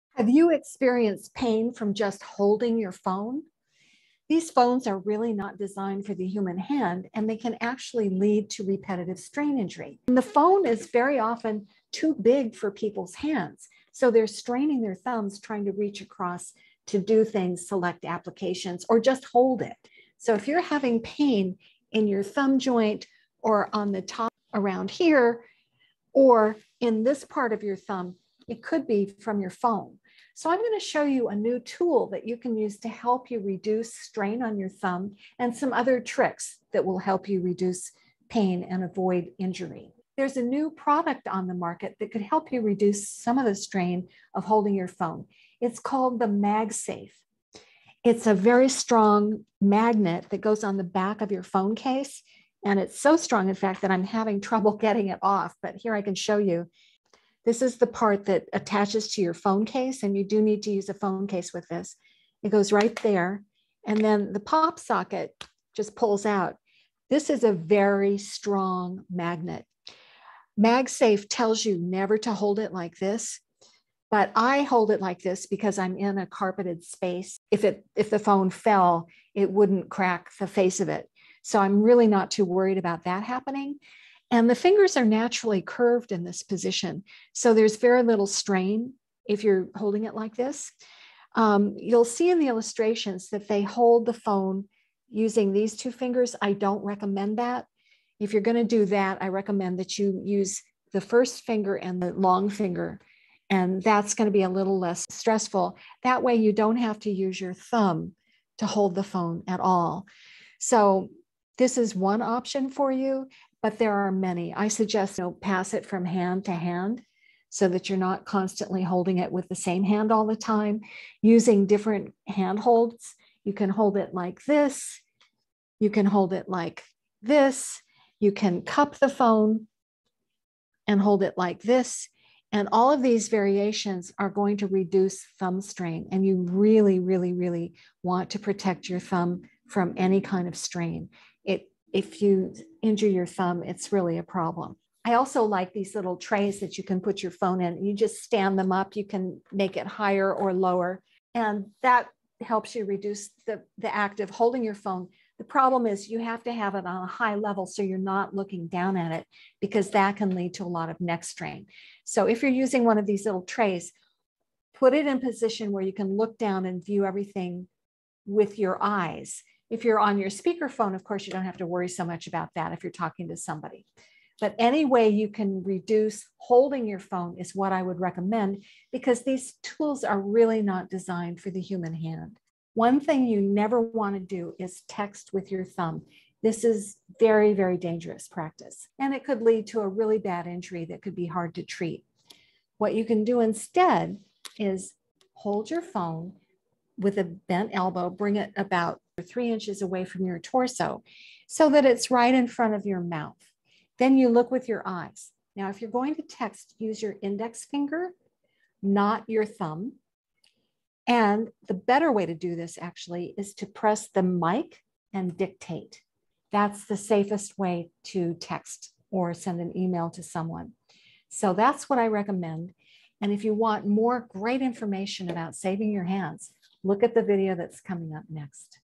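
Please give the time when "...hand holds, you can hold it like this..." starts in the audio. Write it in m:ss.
2:02.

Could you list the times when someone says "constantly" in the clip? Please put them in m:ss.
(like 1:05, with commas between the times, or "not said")
1:58.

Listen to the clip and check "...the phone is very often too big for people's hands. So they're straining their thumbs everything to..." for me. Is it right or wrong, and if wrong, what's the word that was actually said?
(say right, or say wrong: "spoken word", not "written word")
wrong: "trying", not "everything".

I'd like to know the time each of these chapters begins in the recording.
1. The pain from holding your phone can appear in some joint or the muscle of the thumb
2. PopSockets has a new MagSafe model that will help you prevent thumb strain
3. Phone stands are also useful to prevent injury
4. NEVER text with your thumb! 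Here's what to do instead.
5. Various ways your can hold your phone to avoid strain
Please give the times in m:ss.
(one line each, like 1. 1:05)
1. 0:24
2. 0:46
3. 2:26
4. 3:04
5. 1:19.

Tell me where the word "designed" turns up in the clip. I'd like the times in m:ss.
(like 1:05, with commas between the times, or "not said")
0:05, 3:00.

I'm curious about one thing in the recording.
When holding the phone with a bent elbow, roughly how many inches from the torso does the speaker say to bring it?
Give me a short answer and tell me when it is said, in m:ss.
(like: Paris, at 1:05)
3 inches, at 3:19.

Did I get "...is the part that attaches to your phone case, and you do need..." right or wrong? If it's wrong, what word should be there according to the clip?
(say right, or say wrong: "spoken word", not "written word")
right.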